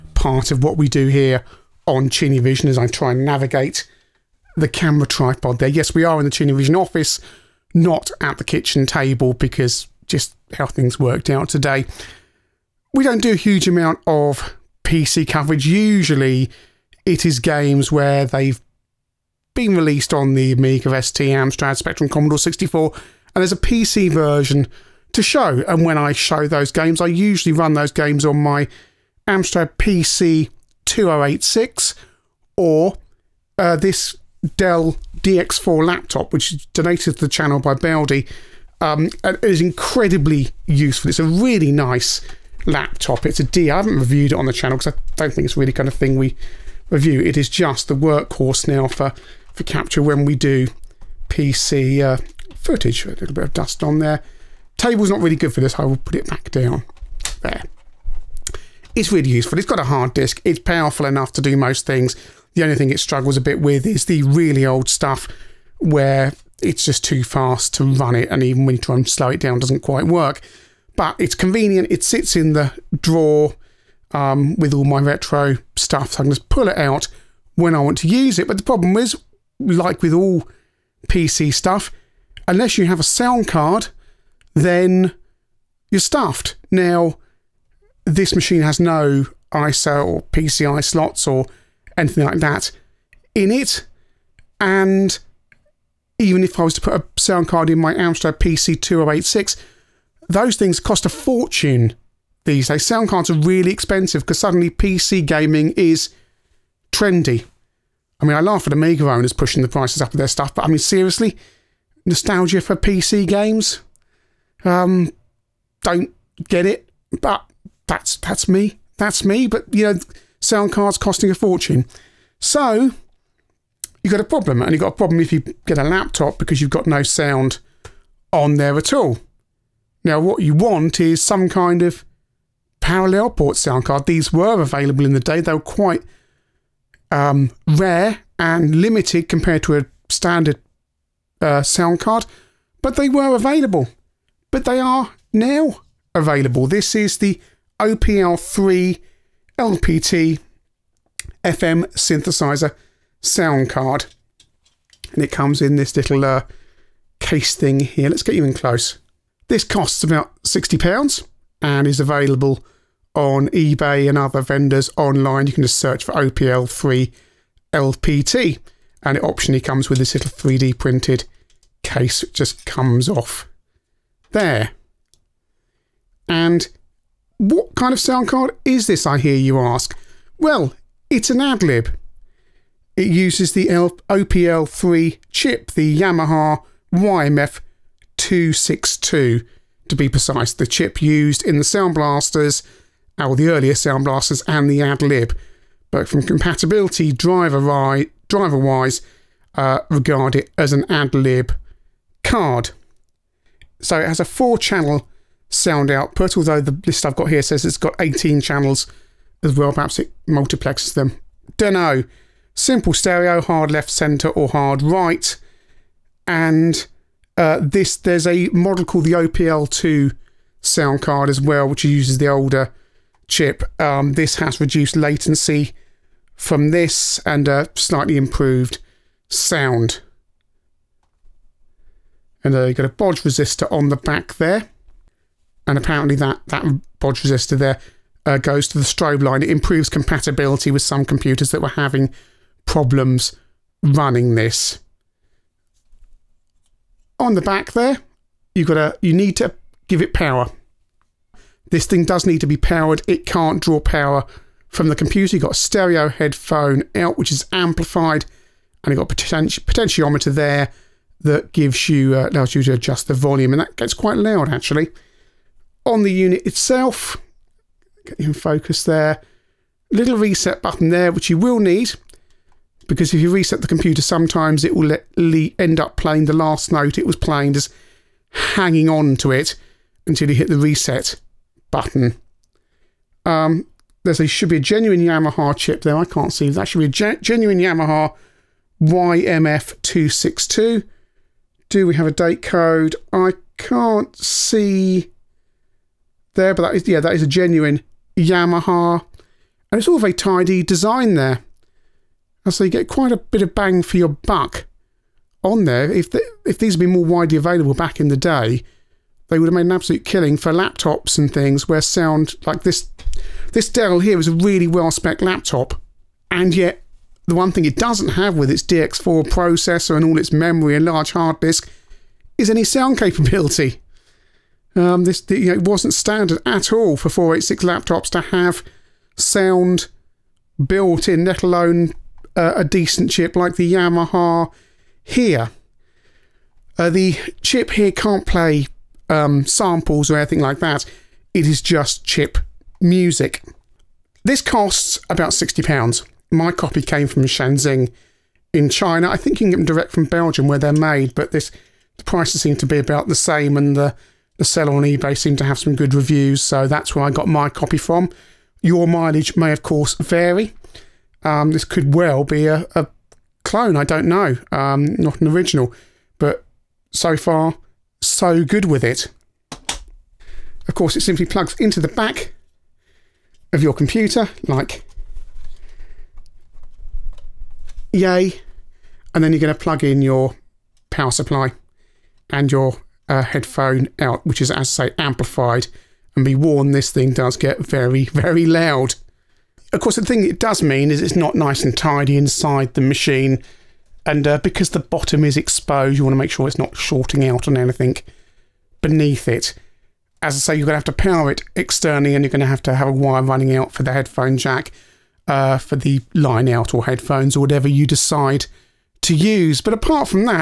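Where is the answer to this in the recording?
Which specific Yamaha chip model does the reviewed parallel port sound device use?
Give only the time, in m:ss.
3:06.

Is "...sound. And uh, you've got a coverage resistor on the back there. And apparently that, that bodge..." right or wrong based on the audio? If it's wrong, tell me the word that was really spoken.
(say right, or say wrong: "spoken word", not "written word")
wrong: "bodge", not "coverage".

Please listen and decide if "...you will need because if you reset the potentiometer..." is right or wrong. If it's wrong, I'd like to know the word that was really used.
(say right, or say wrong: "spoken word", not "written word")
wrong: "computer", not "potentiometer".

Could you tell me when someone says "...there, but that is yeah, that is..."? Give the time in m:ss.
4:56.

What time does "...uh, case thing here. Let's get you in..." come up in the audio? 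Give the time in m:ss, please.
2:36.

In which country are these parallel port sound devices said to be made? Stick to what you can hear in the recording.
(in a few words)
Belgium.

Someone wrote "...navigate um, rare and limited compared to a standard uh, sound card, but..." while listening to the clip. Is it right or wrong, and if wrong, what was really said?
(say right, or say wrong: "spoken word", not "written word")
wrong: "quite", not "navigate".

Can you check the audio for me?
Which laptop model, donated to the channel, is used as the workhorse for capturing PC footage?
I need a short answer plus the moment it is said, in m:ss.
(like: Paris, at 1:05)
Dell DX4, at 0:34.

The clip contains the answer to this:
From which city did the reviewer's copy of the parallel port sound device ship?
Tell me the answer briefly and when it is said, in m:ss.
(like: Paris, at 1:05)
Shenzhen, at 5:47.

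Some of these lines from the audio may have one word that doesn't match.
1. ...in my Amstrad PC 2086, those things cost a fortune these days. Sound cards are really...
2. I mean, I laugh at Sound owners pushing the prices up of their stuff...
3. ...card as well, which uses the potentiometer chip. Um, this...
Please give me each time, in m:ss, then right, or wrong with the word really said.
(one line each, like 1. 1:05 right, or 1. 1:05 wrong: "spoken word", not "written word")
1. 1:37 right
2. 1:48 wrong: "Amiga", not "Sound"
3. 3:41 wrong: "older", not "potentiometer".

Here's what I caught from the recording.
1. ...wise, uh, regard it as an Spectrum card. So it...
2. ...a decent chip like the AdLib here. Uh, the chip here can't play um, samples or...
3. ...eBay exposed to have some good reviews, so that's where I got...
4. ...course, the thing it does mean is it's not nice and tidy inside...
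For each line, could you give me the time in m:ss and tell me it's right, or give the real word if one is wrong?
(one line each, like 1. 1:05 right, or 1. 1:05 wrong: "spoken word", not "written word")
1. 3:17 wrong: "AdLib", not "Spectrum"
2. 5:32 wrong: "Yamaha", not "AdLib"
3. 5:54 wrong: "seemed", not "exposed"
4. 6:29 right.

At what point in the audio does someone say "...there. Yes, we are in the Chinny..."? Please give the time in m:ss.
0:05.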